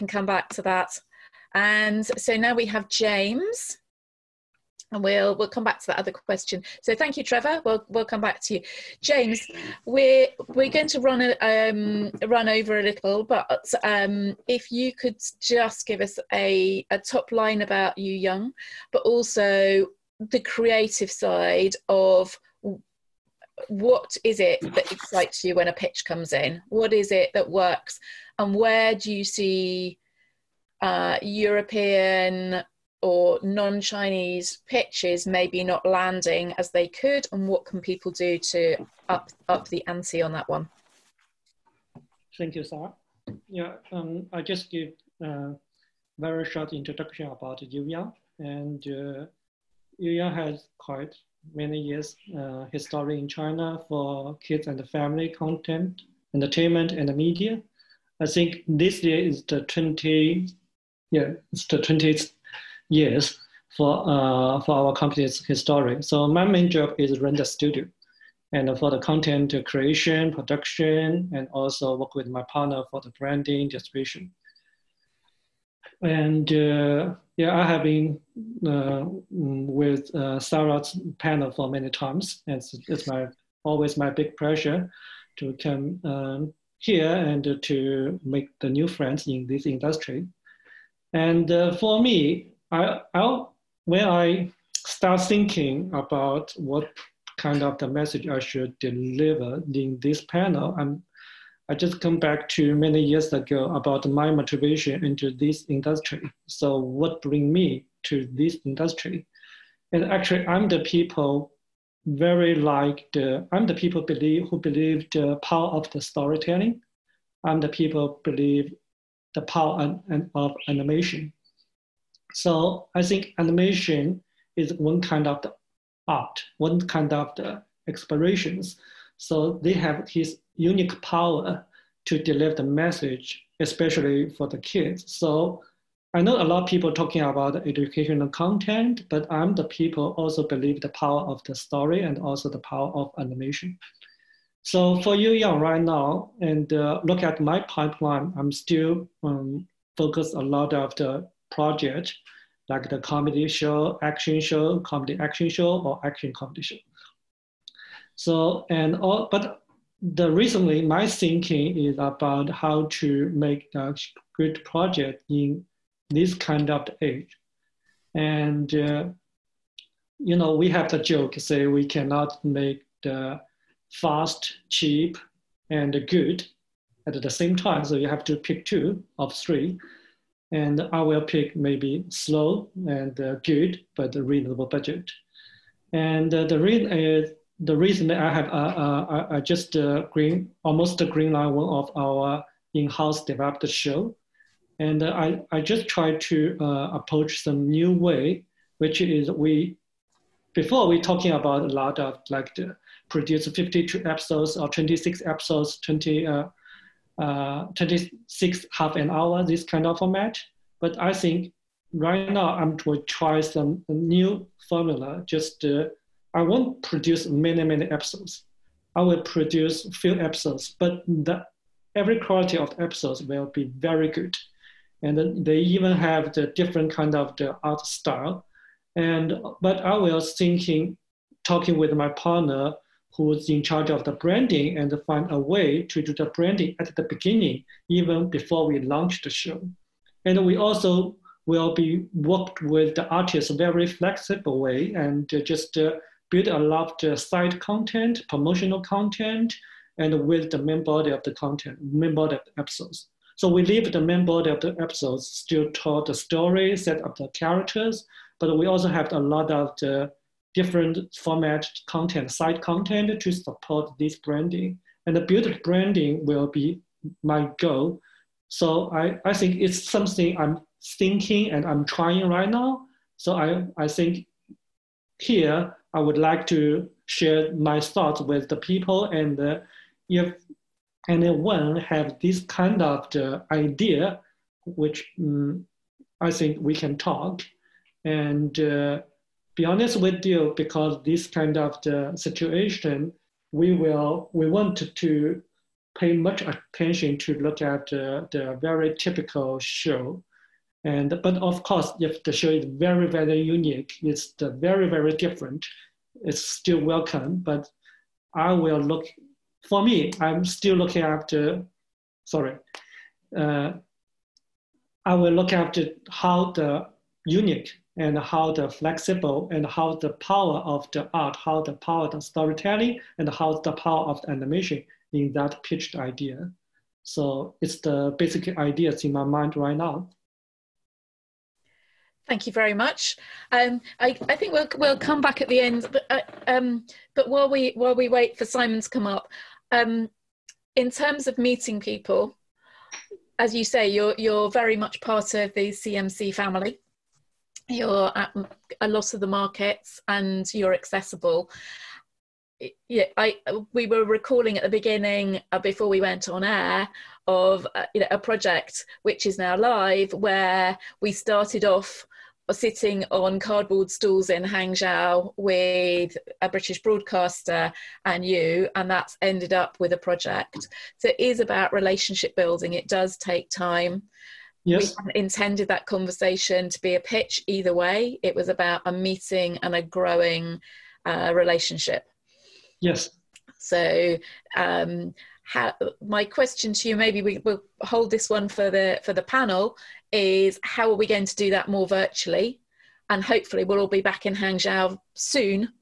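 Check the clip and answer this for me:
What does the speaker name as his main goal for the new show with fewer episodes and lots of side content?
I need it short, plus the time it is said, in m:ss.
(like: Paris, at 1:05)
build branding, at 4:25.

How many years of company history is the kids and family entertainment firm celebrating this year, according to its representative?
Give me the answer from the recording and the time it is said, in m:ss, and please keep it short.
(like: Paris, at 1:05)
20, at 1:01.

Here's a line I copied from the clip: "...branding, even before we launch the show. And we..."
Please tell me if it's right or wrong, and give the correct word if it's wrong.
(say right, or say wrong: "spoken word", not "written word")
wrong: "beginning", not "branding".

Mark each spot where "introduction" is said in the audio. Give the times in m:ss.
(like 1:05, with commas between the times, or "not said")
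0:46.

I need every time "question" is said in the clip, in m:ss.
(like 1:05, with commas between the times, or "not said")
0:06, 6:26.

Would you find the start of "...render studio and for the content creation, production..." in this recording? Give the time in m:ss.
1:07.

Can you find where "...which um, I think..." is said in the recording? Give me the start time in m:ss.
4:44.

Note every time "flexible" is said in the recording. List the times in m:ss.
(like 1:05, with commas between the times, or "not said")
4:03, 5:18.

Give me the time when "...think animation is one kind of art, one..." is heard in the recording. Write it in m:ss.
2:03.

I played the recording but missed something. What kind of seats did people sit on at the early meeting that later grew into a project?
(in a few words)
cardboard stools.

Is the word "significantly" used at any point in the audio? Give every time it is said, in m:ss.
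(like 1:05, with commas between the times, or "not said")
not said.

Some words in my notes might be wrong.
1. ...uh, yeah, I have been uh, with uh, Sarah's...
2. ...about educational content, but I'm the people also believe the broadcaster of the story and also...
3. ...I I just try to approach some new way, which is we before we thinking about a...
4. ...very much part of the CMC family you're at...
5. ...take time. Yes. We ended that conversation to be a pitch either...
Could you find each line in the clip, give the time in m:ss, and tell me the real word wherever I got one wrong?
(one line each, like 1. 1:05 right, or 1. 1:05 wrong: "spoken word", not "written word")
1. 1:16 right
2. 2:17 wrong: "power", not "broadcaster"
3. 3:15 wrong: "talking", not "thinking"
4. 5:44 right
5. 6:13 wrong: "intended", not "ended".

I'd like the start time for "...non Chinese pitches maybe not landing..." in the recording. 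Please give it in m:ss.
0:33.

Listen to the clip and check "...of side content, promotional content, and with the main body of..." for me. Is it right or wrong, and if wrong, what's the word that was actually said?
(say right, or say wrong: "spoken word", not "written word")
right.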